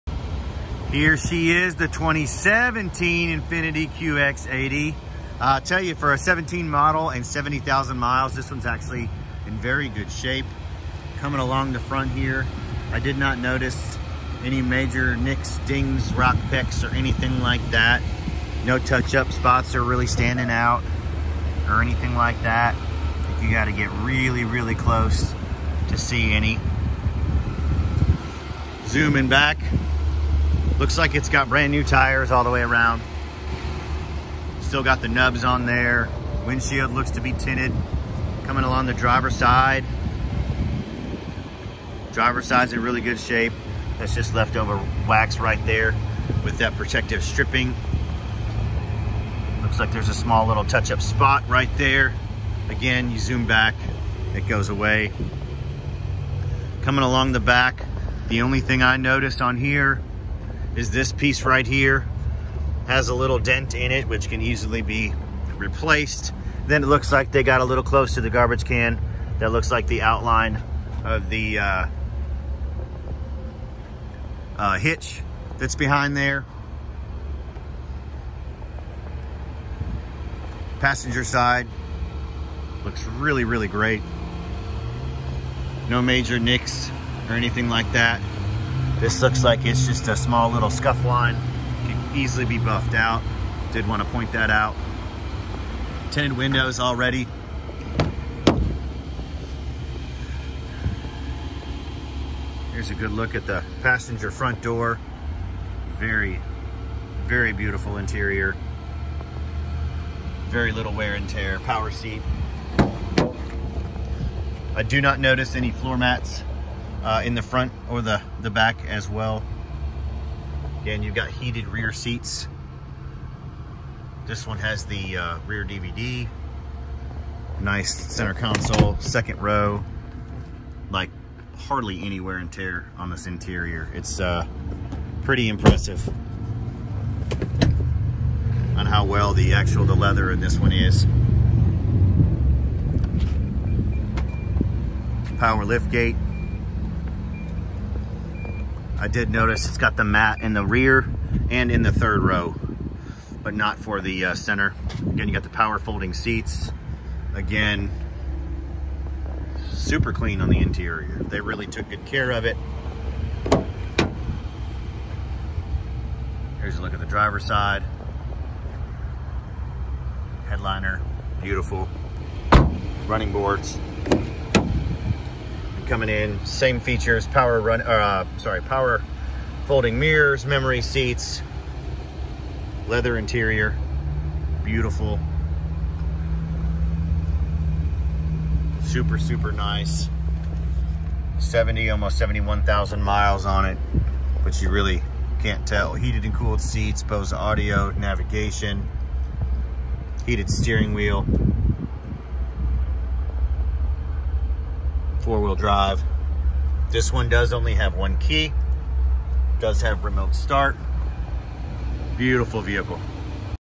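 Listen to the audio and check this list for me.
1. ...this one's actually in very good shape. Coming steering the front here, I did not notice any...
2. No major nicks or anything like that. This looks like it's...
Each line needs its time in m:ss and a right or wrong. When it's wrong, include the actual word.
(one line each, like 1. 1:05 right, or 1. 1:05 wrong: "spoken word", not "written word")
1. 0:08 wrong: "along", not "steering"
2. 1:25 right.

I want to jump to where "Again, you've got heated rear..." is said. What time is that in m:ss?
2:00.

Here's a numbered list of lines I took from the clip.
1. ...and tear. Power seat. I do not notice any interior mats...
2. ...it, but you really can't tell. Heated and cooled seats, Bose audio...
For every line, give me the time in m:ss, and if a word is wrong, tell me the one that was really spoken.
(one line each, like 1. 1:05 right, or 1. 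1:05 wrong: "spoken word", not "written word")
1. 1:51 wrong: "floor", not "interior"
2. 3:13 right.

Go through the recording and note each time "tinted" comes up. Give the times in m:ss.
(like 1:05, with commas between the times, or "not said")
0:37, 1:36.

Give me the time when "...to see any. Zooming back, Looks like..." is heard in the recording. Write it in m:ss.
0:25.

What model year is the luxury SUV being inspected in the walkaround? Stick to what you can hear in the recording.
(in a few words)
2017.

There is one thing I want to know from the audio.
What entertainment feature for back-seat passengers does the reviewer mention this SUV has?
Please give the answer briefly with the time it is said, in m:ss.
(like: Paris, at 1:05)
rear DVD, at 2:05.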